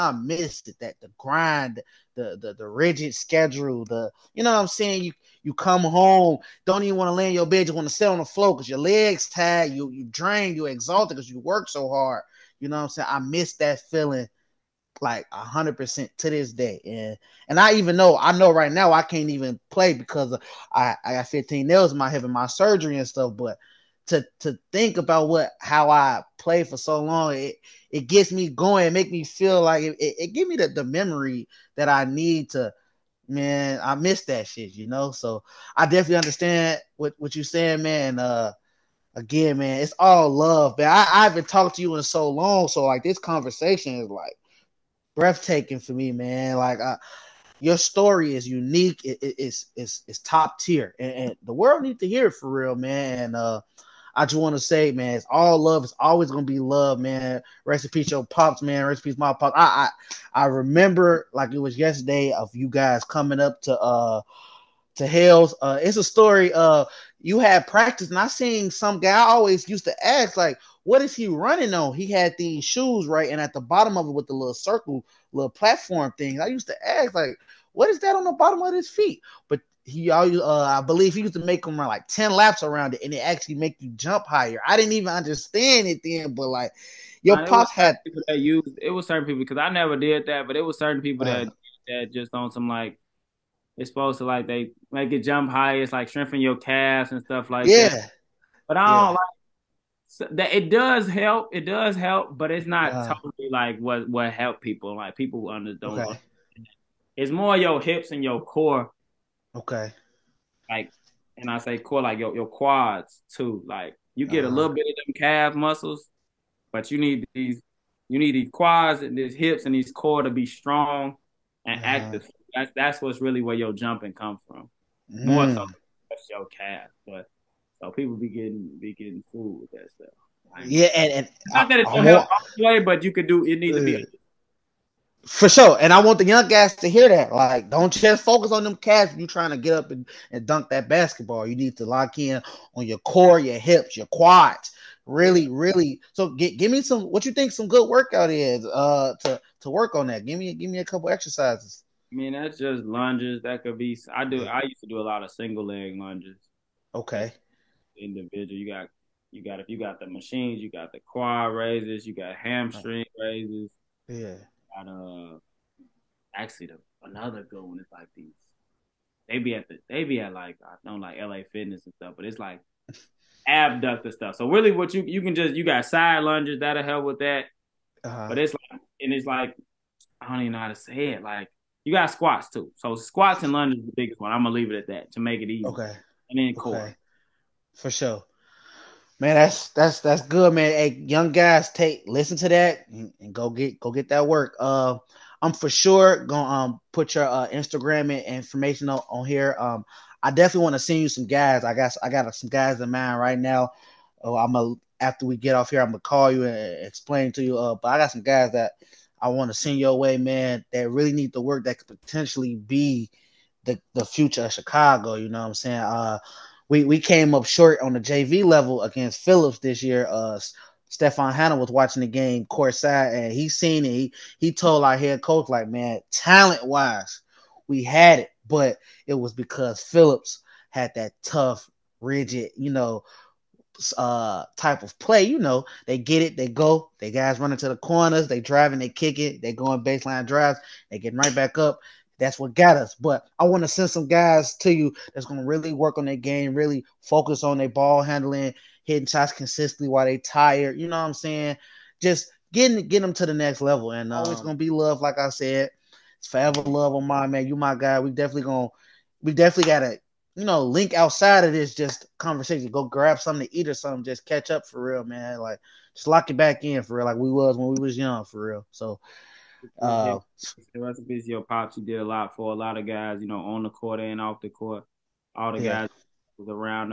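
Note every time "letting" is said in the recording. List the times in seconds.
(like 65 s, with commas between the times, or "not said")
not said.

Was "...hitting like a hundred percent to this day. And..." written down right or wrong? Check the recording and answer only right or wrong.
wrong.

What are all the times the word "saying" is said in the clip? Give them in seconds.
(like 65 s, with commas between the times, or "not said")
4 s, 12 s, 37 s, 215 s, 251 s.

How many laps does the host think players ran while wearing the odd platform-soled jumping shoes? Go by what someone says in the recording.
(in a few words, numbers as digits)
10.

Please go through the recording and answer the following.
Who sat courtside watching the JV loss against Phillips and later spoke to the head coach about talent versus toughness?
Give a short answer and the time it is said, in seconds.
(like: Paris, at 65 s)
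Stefan Hanna, at 220 s.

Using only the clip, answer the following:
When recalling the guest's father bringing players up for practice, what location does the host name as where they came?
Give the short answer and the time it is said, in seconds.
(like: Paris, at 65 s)
Hales, at 65 s.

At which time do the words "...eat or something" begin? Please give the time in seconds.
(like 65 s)
263 s.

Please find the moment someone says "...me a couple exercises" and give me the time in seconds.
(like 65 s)
150 s.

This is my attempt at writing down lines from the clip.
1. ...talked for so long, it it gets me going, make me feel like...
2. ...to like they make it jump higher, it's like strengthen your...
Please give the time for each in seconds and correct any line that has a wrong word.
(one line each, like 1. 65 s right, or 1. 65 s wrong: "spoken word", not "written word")
1. 26 s wrong: "played", not "talked"
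2. 94 s right.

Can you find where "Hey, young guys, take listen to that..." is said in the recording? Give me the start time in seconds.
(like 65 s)
190 s.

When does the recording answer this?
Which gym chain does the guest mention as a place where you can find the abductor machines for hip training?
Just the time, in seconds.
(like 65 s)
171 s.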